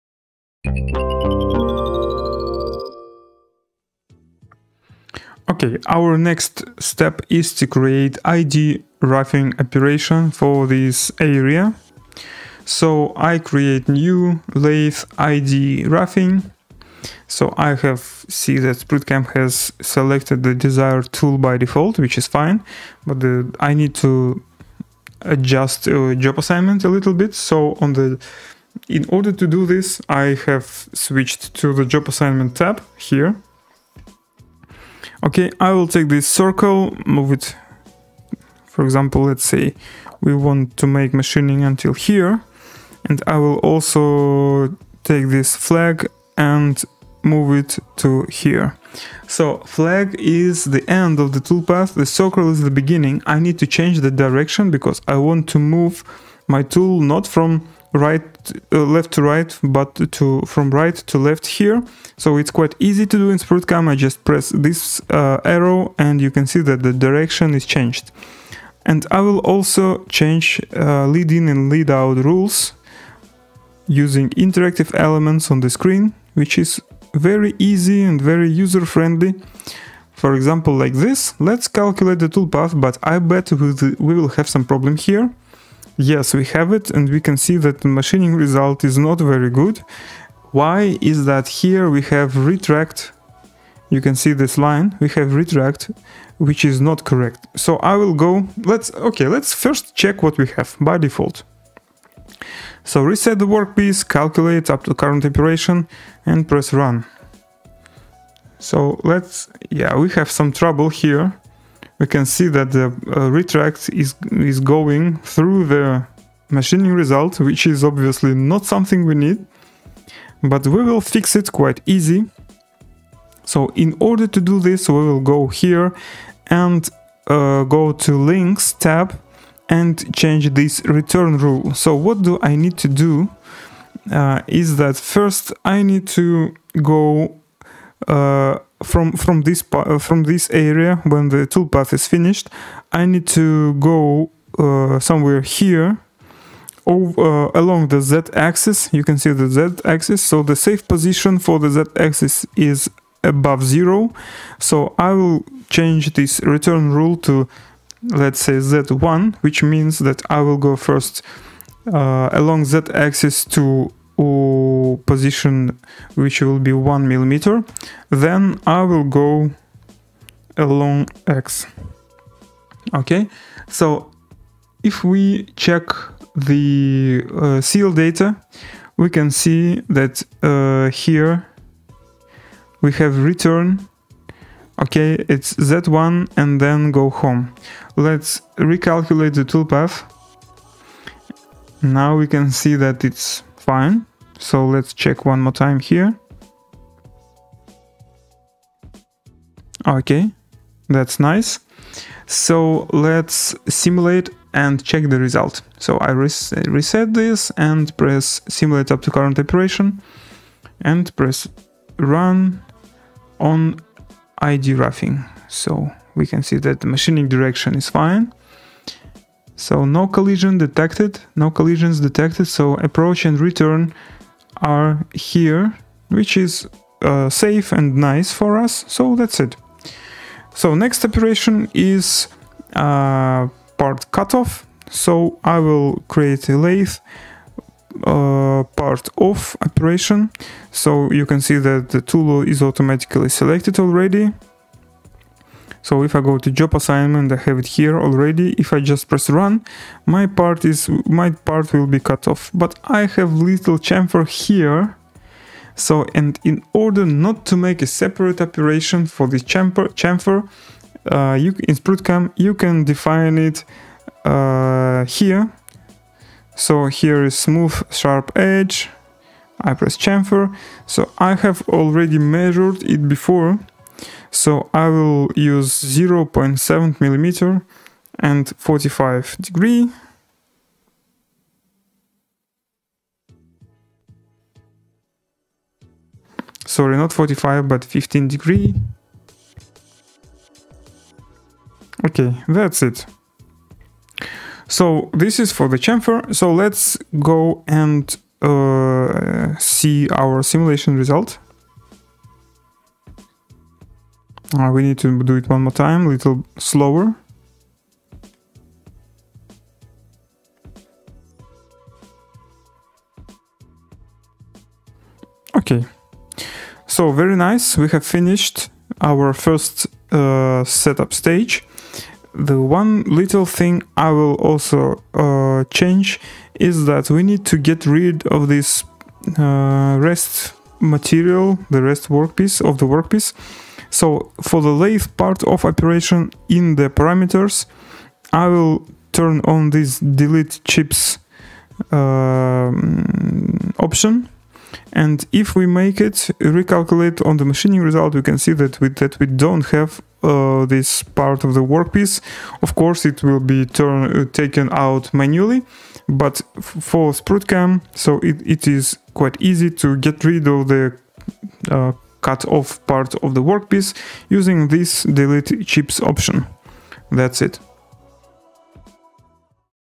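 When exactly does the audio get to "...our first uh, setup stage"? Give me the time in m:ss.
5:18.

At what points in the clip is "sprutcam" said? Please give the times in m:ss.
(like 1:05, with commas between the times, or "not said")
0:18, 1:03, 4:21, 5:57.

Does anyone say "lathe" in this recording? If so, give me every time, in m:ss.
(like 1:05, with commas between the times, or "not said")
0:14, 3:56, 5:34.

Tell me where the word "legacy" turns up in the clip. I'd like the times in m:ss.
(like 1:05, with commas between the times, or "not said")
not said.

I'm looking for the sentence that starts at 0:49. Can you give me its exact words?
So flag is the end of the toolpath, the circle is the beginning.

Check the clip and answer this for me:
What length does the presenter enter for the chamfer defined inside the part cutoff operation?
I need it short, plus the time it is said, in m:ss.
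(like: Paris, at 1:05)
0.7 millimeter, at 4:35.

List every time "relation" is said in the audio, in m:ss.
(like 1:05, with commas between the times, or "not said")
not said.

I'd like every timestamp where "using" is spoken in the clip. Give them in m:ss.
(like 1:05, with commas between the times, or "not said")
1:13, 6:04.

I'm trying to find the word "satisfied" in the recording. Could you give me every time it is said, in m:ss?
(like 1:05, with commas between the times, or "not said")
not said.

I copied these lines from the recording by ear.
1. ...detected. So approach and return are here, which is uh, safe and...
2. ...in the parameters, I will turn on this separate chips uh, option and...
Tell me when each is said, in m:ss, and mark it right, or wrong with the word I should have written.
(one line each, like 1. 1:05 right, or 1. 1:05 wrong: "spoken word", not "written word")
1. 3:41 right
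2. 5:36 wrong: "delete", not "separate".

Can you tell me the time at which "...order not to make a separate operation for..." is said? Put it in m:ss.
4:16.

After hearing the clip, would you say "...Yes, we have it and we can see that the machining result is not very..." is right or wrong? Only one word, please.
right.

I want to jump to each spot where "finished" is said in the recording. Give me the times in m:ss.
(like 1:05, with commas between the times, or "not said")
2:22, 5:18.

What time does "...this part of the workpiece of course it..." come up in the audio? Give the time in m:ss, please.
5:50.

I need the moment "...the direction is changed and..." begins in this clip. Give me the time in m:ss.
1:06.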